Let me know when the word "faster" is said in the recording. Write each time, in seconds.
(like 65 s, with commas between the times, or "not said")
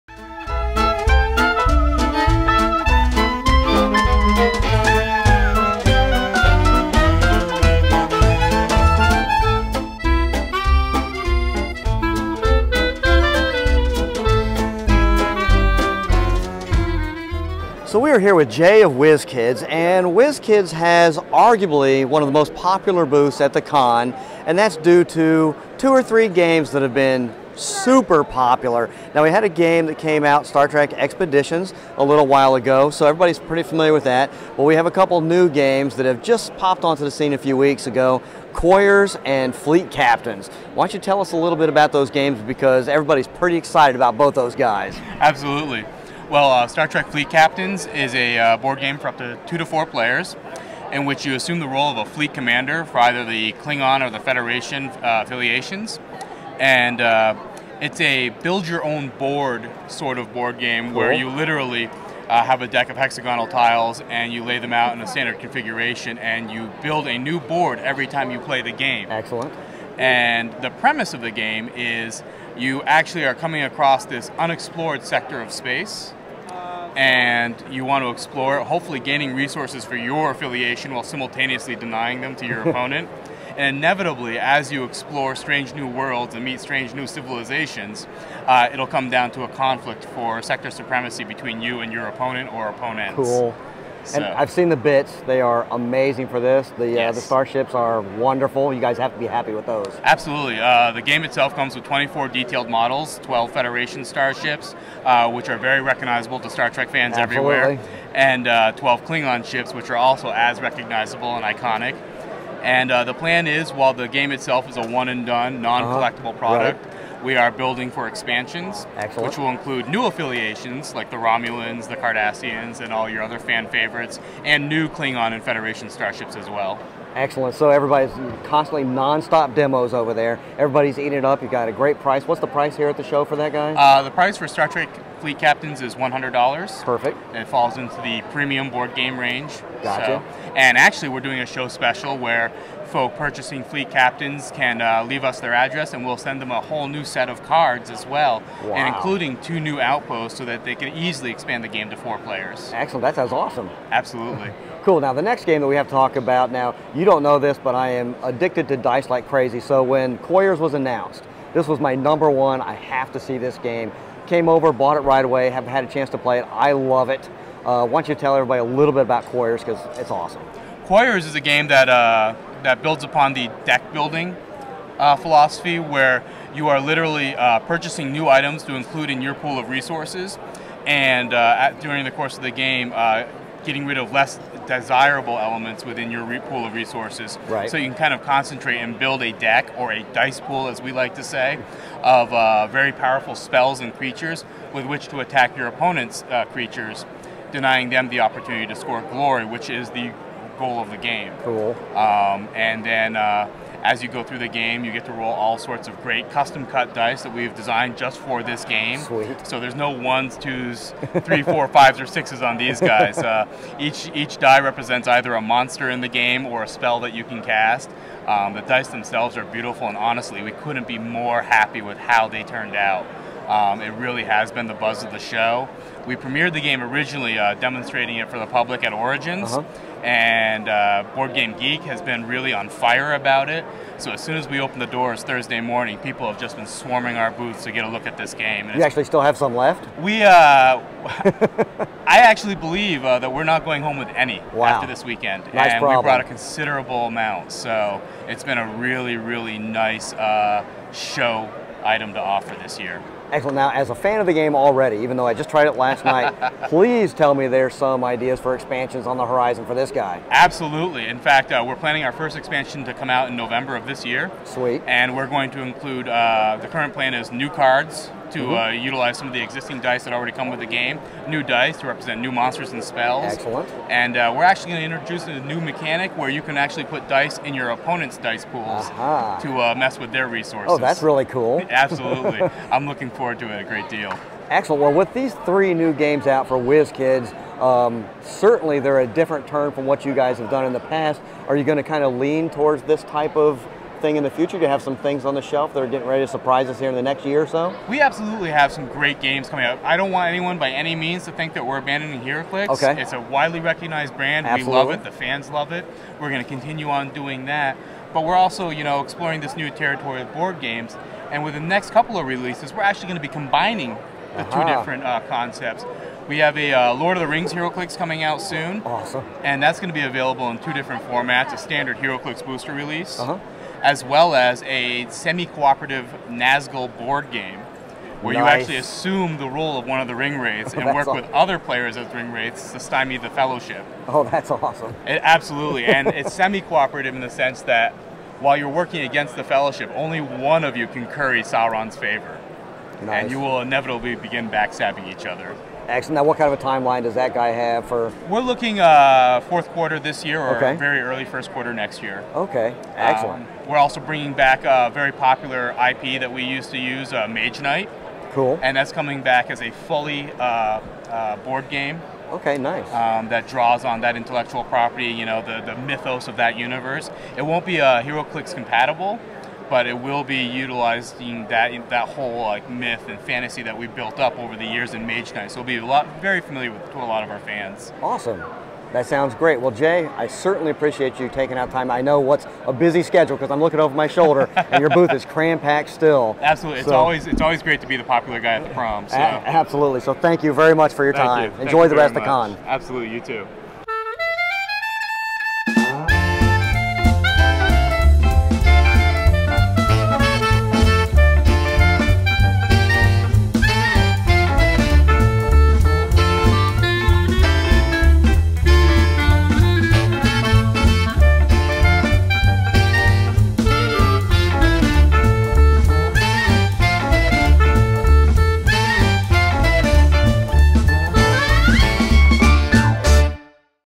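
not said.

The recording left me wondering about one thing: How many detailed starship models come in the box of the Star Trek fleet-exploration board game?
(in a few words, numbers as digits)
24.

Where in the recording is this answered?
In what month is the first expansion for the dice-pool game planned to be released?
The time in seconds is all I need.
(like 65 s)
263 s.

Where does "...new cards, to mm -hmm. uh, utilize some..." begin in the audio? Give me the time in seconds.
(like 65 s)
267 s.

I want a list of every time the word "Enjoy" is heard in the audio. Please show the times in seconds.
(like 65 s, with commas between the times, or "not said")
391 s.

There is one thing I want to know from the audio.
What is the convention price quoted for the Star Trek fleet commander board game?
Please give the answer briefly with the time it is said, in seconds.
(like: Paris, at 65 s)
$100, at 135 s.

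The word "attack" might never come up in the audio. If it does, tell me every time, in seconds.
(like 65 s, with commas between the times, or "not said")
195 s.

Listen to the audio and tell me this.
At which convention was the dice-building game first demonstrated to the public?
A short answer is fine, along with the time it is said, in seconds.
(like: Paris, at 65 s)
Origins, at 228 s.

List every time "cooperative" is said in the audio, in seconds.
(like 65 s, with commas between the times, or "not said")
325 s, 336 s.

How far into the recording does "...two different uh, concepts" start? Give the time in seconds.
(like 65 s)
314 s.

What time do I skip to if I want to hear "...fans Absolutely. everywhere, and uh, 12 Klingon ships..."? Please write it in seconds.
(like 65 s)
106 s.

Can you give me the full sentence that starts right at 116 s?
Right we are building for expansions, Excellent.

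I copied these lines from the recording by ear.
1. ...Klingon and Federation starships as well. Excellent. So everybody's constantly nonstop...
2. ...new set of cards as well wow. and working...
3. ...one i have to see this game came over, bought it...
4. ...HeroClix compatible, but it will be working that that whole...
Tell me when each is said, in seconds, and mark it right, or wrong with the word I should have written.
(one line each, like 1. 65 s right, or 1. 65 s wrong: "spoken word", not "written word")
1. 124 s right
2. 146 s wrong: "including", not "working"
3. 162 s right
4. 368 s wrong: "utilizing", not "working".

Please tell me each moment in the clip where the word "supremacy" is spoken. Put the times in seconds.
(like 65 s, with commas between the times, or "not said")
90 s.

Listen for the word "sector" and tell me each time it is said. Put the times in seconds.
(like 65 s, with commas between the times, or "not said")
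75 s, 90 s.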